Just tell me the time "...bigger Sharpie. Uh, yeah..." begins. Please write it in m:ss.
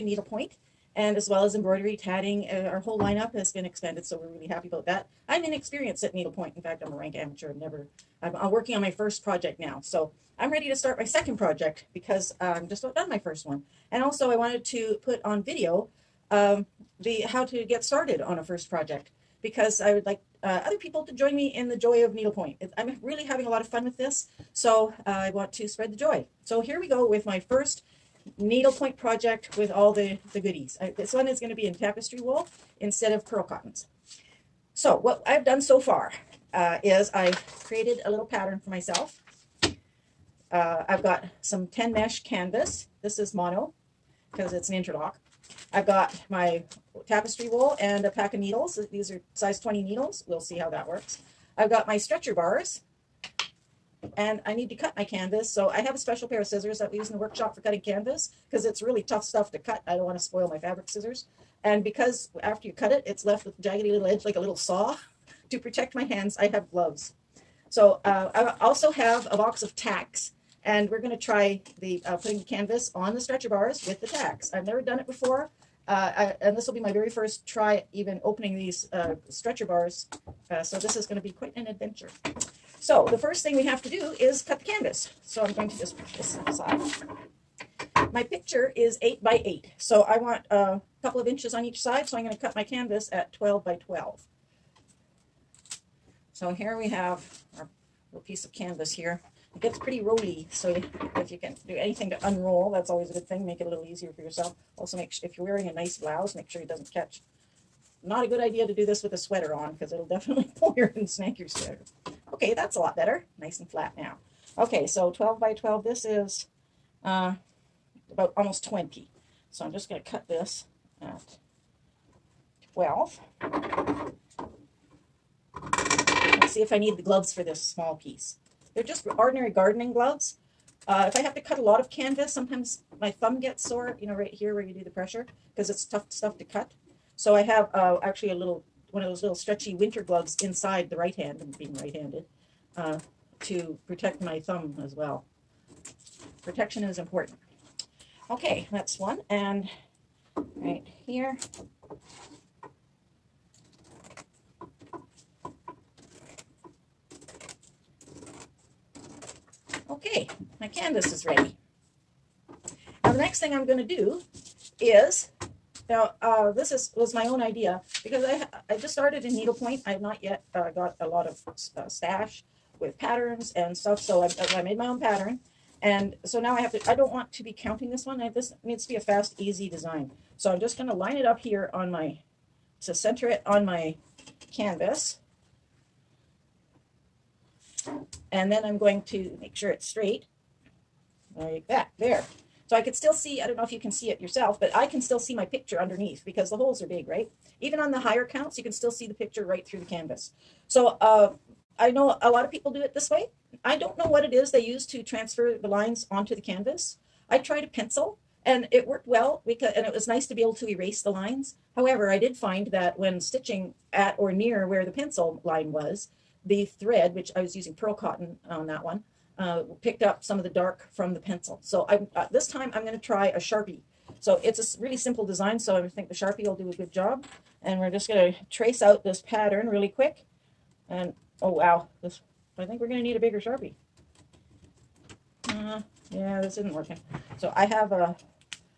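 3:53.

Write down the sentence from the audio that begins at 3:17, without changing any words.
Even on the higher counts, you can still see the picture right through the canvas.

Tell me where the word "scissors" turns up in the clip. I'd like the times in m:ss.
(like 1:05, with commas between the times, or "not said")
0:56, 1:00.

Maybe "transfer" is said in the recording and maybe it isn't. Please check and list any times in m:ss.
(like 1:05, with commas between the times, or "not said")
3:25.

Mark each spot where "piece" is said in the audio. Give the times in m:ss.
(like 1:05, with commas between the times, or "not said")
1:38, 2:07.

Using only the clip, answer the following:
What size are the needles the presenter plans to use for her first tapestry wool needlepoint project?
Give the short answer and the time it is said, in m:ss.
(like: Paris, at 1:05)
20, at 0:49.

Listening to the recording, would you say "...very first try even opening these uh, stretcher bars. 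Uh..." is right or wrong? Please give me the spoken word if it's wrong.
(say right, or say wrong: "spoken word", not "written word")
right.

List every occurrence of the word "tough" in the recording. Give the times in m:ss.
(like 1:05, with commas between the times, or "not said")
0:59, 2:15.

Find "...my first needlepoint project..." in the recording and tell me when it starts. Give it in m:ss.
0:27.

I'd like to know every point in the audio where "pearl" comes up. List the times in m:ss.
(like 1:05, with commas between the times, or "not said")
0:33, 3:37.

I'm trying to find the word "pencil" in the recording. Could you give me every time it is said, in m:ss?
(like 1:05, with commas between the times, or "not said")
3:27, 3:34, 3:41.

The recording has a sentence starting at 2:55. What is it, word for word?
And so now I have to, I don't want to be counting this one.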